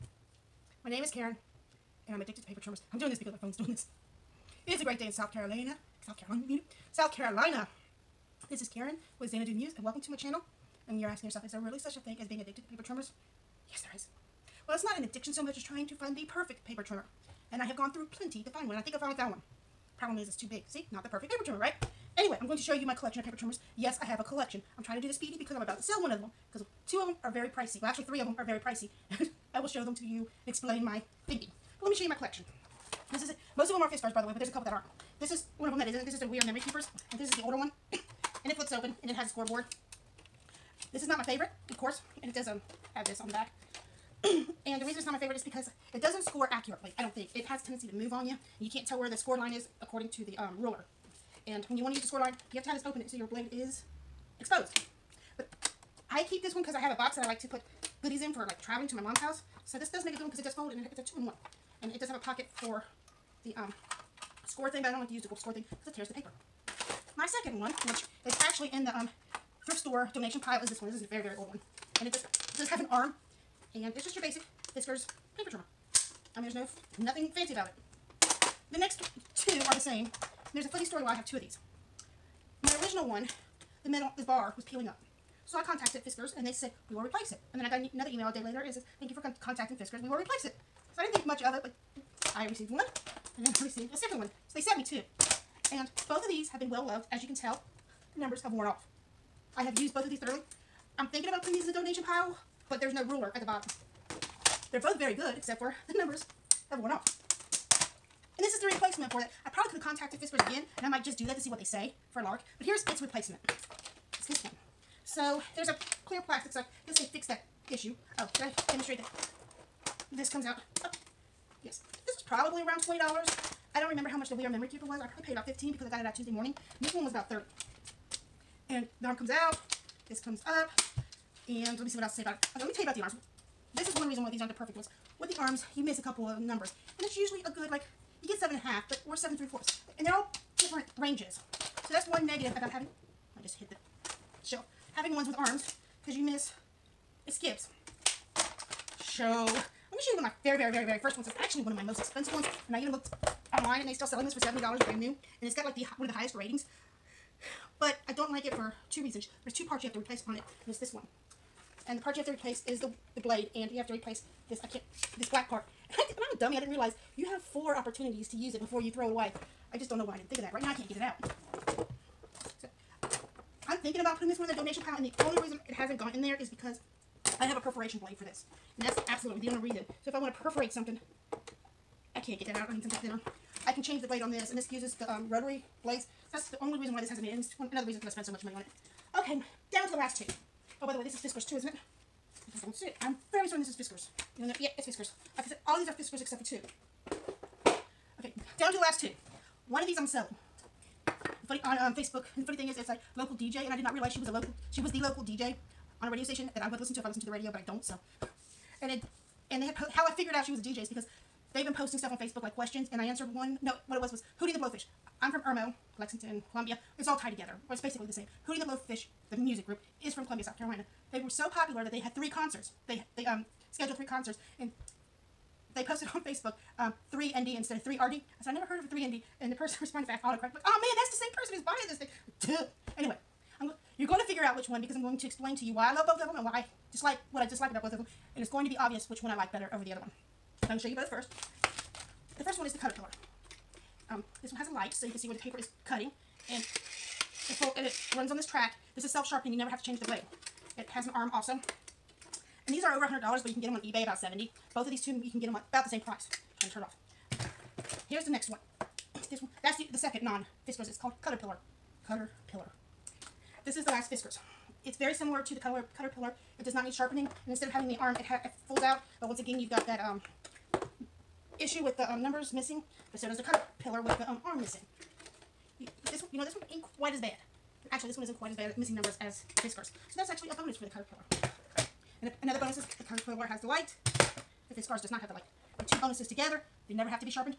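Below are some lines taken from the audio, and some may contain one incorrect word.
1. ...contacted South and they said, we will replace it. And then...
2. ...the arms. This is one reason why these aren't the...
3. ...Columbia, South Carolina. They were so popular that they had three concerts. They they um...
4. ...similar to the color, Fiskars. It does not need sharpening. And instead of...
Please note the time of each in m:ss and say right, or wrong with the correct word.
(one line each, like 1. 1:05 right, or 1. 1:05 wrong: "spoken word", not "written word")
1. 1:25 wrong: "Fiskars", not "South"
2. 2:12 right
3. 3:40 right
4. 4:25 wrong: "Cutterpillar", not "Fiskars".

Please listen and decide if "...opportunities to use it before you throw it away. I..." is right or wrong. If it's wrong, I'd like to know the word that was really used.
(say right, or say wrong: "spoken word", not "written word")
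right.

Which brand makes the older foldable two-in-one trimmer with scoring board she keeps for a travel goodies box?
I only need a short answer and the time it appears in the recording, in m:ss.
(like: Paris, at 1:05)
We Are Memory Keepers, at 0:36.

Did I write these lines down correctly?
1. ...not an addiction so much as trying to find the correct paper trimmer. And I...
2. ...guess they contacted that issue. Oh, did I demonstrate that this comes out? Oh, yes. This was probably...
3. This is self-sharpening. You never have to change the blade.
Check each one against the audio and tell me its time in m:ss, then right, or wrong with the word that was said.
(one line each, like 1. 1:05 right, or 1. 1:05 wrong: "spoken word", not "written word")
1. 0:14 wrong: "perfect", not "correct"
2. 1:56 wrong: "fixed", not "contacted"
3. 4:08 right.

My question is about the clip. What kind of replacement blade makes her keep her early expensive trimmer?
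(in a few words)
perforation blade.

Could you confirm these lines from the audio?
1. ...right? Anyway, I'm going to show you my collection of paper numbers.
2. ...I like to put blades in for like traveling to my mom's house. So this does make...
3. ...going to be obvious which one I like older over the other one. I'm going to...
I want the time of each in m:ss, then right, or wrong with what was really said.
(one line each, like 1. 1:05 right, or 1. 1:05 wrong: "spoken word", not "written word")
1. 0:21 wrong: "trimmers", not "numbers"
2. 0:57 wrong: "goodies", not "blades"
3. 3:58 wrong: "better", not "older".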